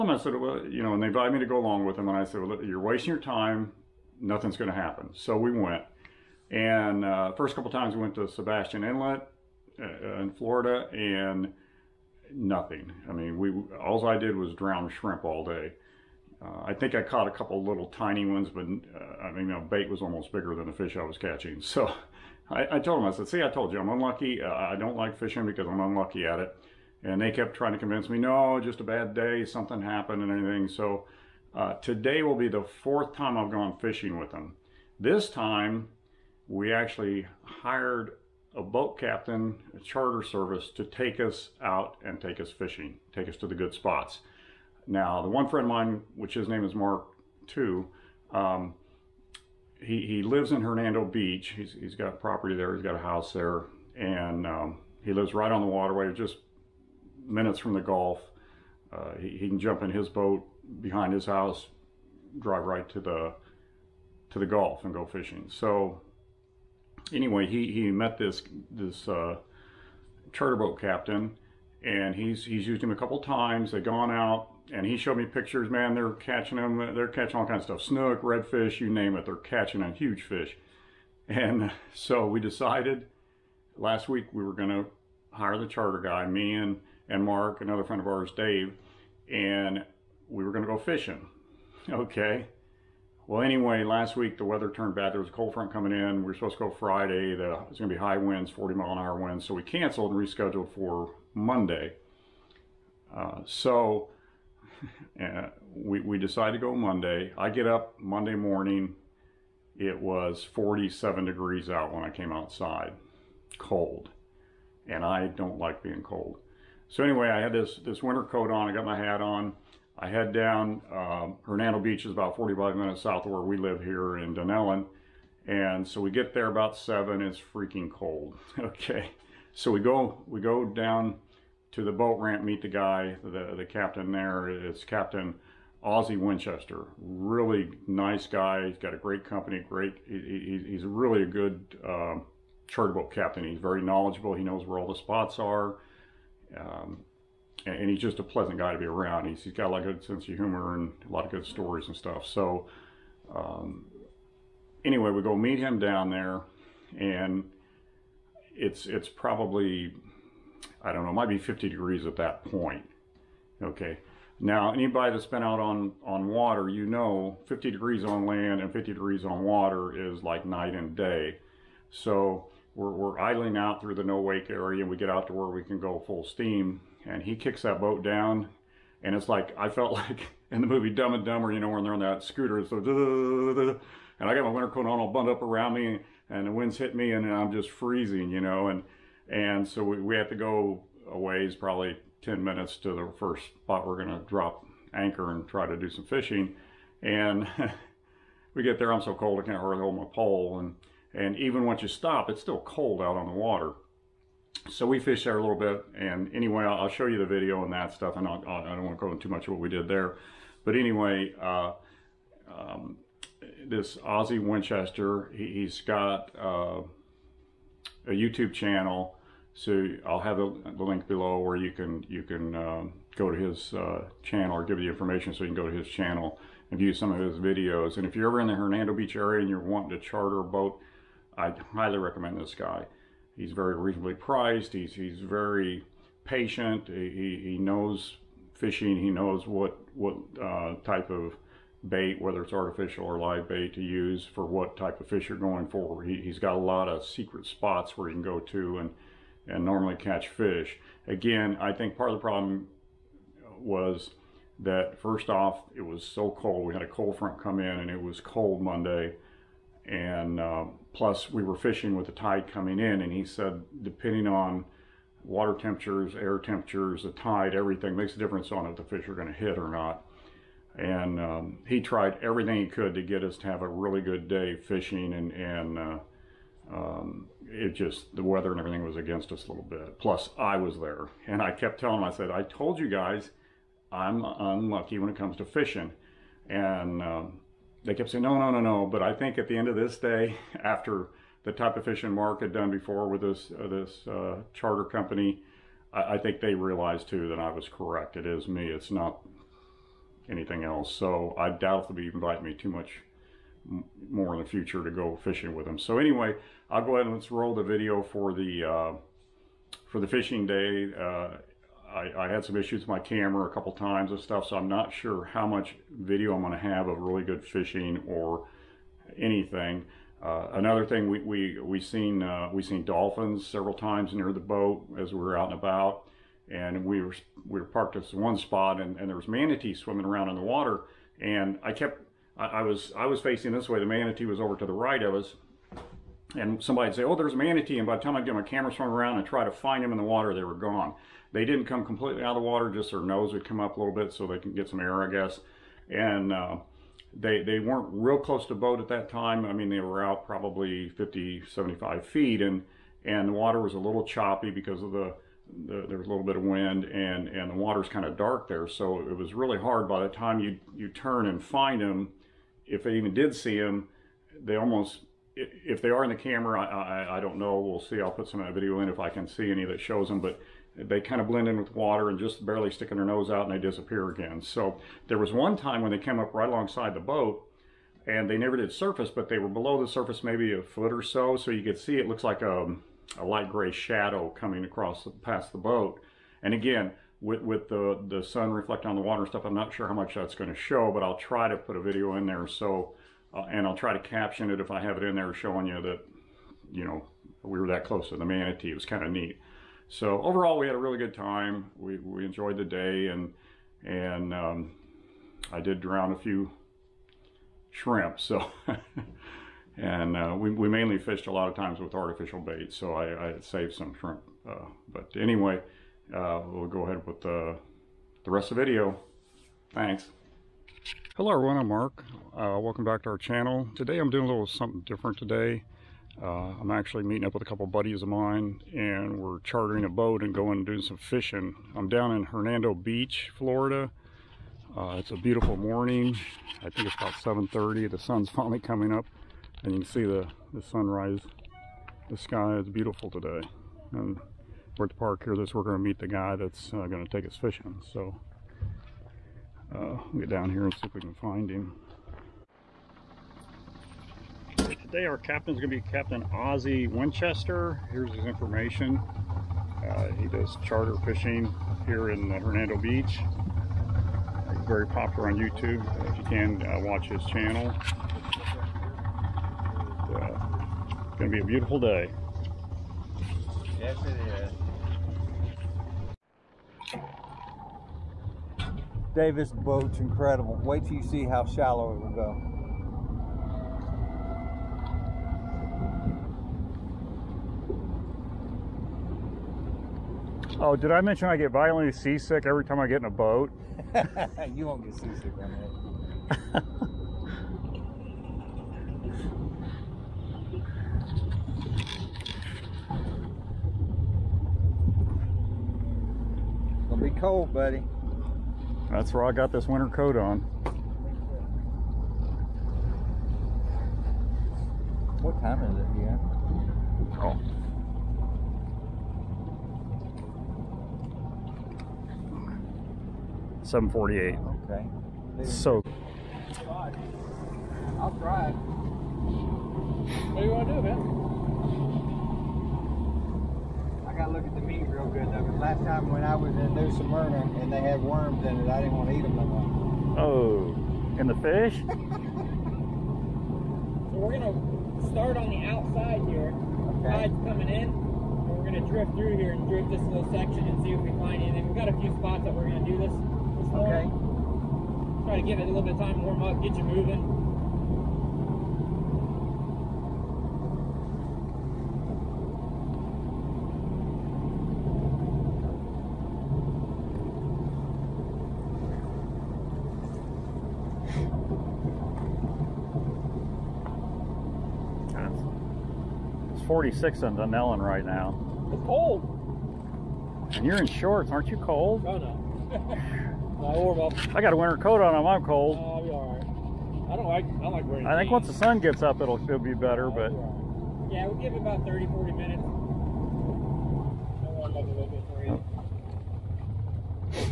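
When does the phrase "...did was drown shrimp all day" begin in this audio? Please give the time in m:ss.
0:14.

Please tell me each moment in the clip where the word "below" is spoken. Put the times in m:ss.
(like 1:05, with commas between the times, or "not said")
3:41, 6:19.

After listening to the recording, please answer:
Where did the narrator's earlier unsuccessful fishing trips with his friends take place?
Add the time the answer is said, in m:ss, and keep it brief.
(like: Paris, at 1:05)
Sebastian Inlet, at 0:08.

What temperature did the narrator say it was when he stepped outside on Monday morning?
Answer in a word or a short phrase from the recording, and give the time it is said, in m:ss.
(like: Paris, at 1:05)
47 degrees, at 1:50.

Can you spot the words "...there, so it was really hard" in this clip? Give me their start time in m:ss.
5:58.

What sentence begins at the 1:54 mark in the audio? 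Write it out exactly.
And I don't like being cold.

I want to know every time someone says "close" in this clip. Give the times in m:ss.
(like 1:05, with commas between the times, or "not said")
5:48, 6:37.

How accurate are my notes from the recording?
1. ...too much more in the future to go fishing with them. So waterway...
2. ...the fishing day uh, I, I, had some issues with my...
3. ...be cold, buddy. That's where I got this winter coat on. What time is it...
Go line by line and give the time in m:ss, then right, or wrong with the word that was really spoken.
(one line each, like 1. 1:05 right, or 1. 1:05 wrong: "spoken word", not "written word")
1. 5:02 wrong: "anyway", not "waterway"
2. 5:10 right
3. 8:27 right.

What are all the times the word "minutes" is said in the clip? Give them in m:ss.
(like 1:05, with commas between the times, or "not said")
0:57, 2:02, 3:12, 9:52.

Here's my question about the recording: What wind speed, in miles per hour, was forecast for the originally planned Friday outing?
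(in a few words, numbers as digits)
40.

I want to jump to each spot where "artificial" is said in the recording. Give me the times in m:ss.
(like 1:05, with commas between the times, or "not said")
4:02, 6:51.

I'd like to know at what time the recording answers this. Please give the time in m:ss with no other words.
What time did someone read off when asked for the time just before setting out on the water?
8:43.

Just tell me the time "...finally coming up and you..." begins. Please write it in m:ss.
7:18.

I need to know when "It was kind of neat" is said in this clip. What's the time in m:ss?
6:38.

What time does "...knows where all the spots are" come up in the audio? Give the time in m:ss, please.
2:24.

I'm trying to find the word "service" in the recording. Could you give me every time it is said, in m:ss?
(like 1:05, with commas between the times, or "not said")
0:40.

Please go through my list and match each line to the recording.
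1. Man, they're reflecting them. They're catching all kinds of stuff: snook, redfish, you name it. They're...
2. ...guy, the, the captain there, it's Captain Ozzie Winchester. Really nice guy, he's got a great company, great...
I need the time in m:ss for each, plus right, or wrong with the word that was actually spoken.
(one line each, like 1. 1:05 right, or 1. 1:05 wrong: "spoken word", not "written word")
1. 1:15 wrong: "catching", not "reflecting"
2. 2:12 right.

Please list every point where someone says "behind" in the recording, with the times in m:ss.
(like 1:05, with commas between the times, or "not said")
1:00.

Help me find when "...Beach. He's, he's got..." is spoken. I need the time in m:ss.
0:51.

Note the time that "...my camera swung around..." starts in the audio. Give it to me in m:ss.
5:38.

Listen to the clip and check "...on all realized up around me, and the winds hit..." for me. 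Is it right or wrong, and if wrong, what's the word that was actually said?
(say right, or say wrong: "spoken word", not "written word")
wrong: "bundled", not "realized".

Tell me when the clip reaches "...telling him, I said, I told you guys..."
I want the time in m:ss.
4:41.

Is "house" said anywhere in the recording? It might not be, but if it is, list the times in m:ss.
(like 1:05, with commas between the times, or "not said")
0:52, 1:01.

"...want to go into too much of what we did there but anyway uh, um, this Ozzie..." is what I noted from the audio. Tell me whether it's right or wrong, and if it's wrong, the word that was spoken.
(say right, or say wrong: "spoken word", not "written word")
right.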